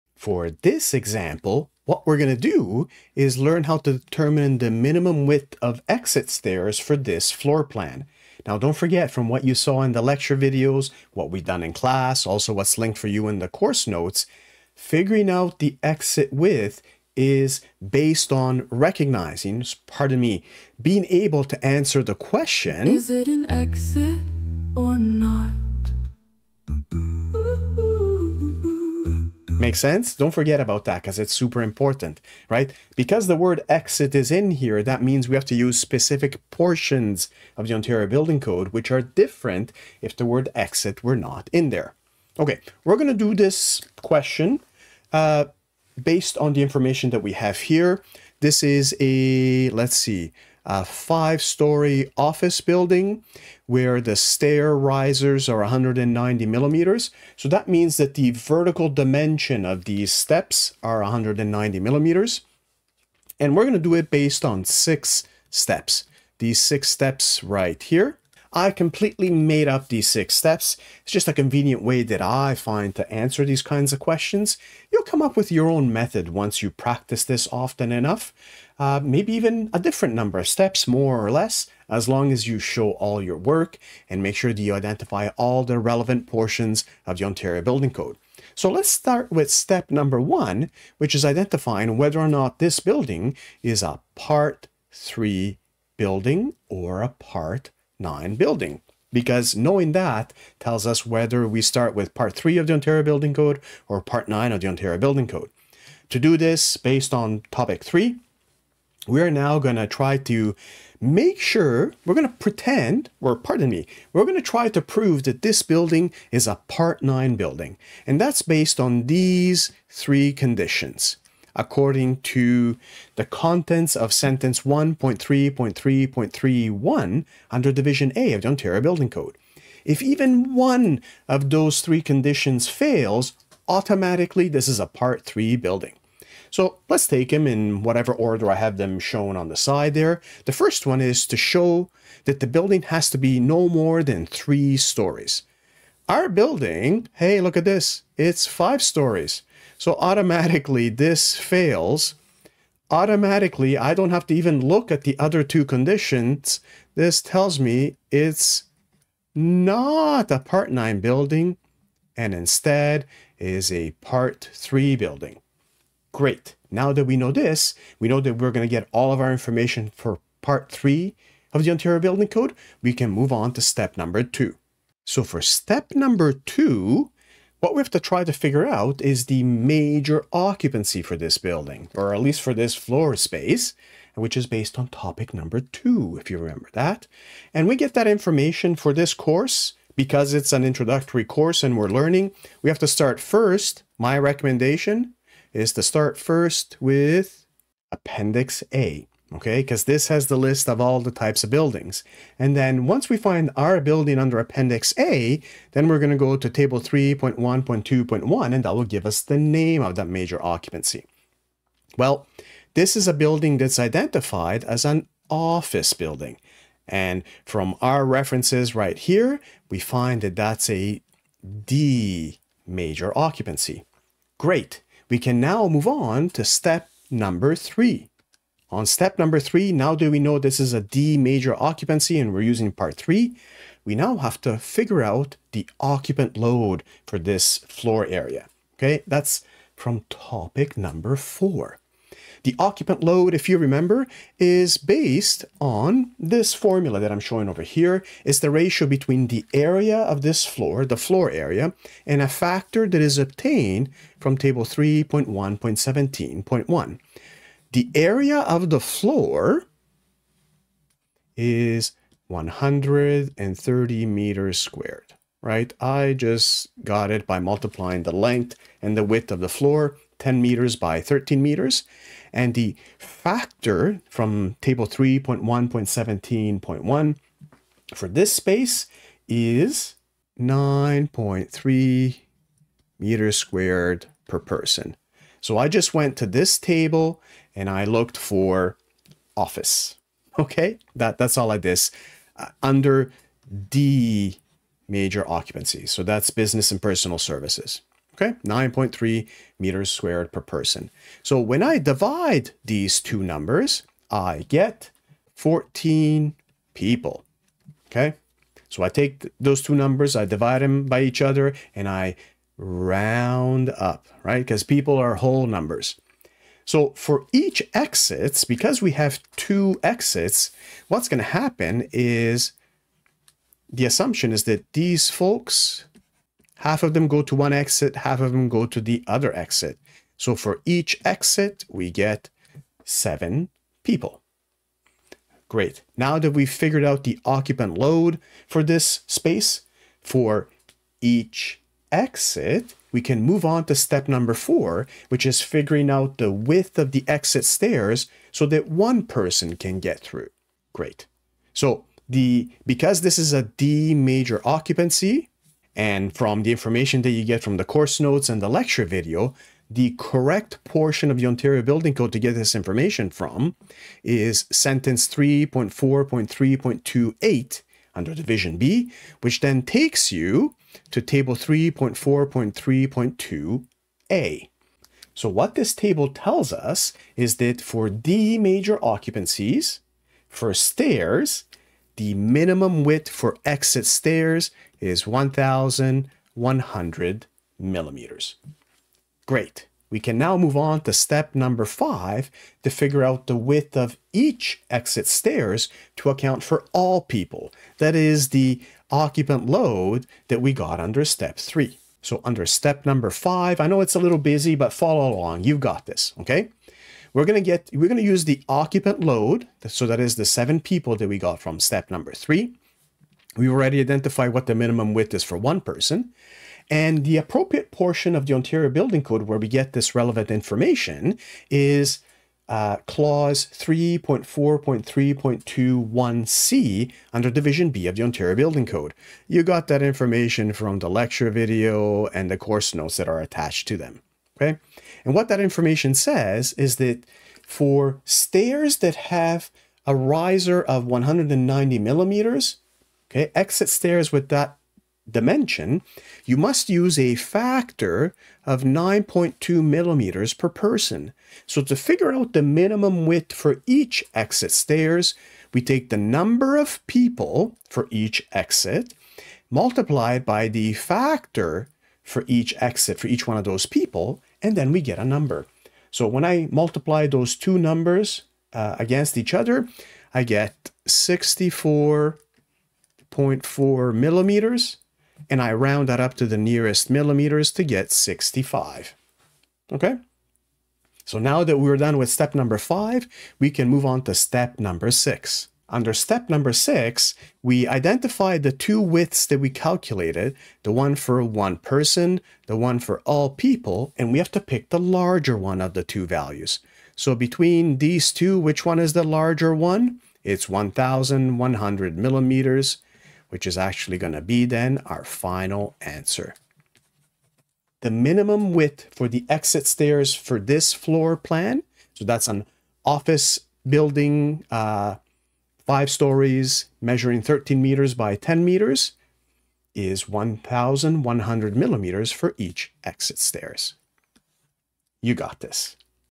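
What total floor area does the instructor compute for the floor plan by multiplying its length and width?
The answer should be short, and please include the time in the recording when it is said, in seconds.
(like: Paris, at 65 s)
130 square meters, at 262 s.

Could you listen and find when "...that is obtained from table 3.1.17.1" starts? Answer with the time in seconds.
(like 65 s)
252 s.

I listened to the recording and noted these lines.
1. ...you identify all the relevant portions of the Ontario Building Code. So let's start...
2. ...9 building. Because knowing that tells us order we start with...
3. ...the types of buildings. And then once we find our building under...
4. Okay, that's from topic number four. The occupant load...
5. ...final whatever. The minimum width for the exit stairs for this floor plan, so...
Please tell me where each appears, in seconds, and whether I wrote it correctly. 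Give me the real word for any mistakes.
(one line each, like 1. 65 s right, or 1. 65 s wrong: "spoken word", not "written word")
1. 84 s right
2. 98 s wrong: "whether", not "order"
3. 200 s right
4. 238 s right
5. 505 s wrong: "answer", not "whatever".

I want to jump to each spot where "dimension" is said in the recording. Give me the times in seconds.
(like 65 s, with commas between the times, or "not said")
58 s, 445 s.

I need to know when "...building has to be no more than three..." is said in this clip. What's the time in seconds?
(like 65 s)
142 s.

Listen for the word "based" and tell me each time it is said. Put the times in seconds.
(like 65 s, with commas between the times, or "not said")
17 s, 46 s, 64 s, 106 s, 118 s, 184 s, 244 s.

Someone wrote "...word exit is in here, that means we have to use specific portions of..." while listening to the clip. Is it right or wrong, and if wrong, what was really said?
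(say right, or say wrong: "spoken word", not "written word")
right.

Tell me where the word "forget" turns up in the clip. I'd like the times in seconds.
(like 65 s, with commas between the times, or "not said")
8 s, 30 s.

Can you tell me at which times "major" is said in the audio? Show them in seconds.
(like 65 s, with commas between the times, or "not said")
179 s, 210 s, 222 s, 231 s, 294 s, 353 s, 378 s.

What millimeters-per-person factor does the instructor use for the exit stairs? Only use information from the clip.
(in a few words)
9.2 millimeters per person.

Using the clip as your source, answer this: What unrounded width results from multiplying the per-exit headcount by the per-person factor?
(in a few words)
64.4 millimeters.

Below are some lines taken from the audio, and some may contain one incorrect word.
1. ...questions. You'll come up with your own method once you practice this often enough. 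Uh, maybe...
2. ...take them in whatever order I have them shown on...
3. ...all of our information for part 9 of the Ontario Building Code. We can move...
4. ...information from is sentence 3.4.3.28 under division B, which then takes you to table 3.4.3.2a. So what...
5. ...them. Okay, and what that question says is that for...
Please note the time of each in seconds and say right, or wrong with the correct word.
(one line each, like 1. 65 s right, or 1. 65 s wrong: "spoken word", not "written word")
1. 73 s right
2. 137 s right
3. 168 s wrong: "3", not "9"
4. 362 s right
5. 433 s wrong: "information", not "question".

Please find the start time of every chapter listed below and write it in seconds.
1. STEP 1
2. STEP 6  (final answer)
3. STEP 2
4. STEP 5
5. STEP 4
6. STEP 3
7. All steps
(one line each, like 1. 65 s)
1. 88 s
2. 480 s
3. 172 s
4. 389 s
5. 342 s
6. 224 s
7. 63 s.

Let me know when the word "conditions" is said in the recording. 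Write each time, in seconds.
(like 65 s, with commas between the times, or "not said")
120 s, 132 s, 155 s.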